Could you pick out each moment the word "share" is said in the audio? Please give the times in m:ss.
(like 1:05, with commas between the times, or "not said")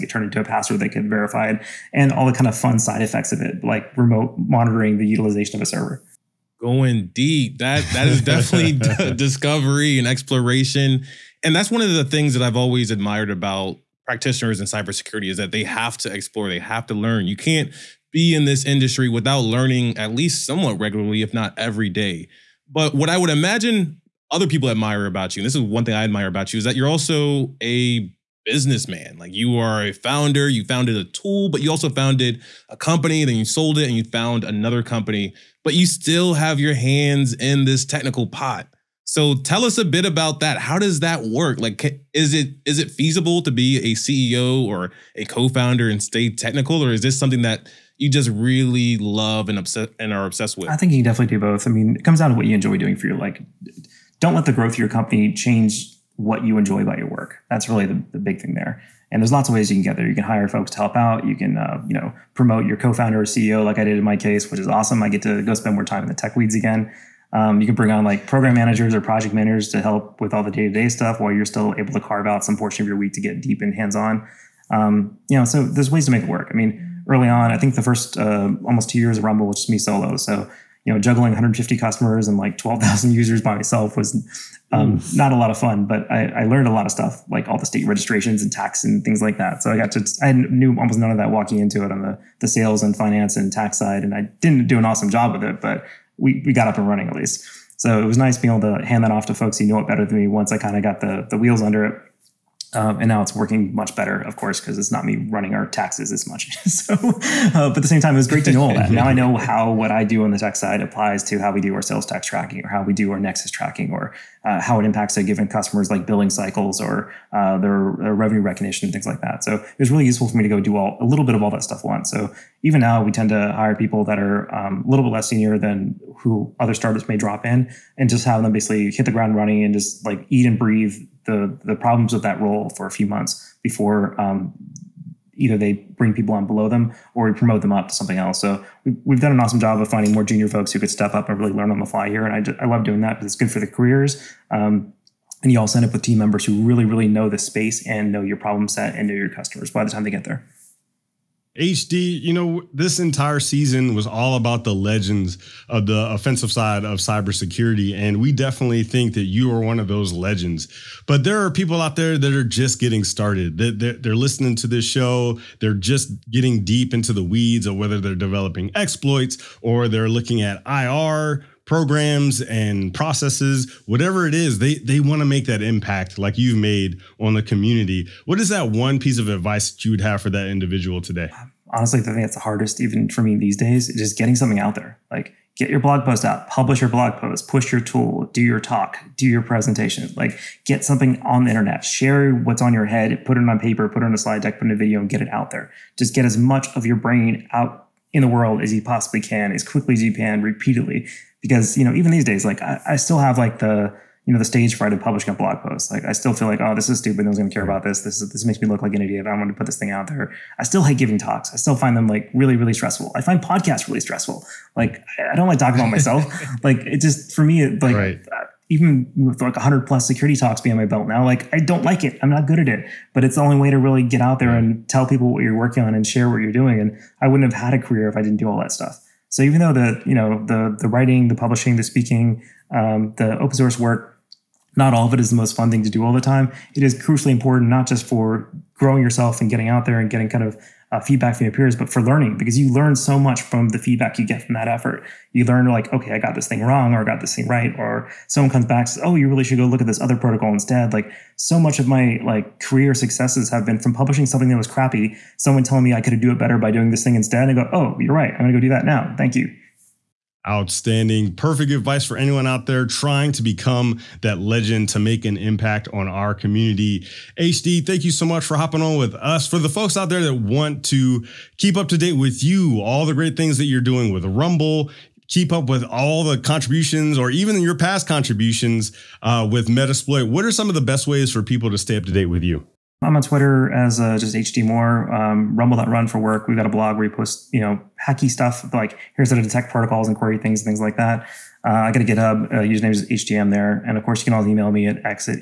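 3:11, 3:46.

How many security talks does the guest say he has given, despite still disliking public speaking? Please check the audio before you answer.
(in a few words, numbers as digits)
100 plus.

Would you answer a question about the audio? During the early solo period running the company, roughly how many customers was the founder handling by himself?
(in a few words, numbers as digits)
150.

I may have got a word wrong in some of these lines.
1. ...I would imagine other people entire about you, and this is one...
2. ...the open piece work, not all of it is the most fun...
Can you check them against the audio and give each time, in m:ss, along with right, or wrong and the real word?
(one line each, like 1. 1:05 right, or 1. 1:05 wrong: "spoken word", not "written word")
1. 0:23 wrong: "admire", not "entire"
2. 3:53 wrong: "source", not "piece".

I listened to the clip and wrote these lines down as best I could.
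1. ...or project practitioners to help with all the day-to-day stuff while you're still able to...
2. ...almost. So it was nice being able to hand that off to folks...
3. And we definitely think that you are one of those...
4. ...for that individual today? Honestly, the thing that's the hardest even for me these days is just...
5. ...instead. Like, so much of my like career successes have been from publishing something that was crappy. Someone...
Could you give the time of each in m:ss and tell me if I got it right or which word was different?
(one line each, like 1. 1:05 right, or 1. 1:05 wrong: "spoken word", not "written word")
1. 1:08 wrong: "managers", not "practitioners"
2. 1:37 wrong: "least", not "almost"
3. 2:37 right
4. 3:00 right
5. 4:10 right.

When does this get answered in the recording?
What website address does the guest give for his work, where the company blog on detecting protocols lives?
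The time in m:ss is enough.
4:45.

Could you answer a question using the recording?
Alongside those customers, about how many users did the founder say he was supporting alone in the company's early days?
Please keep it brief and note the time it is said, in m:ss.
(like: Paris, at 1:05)
12,000, at 1:22.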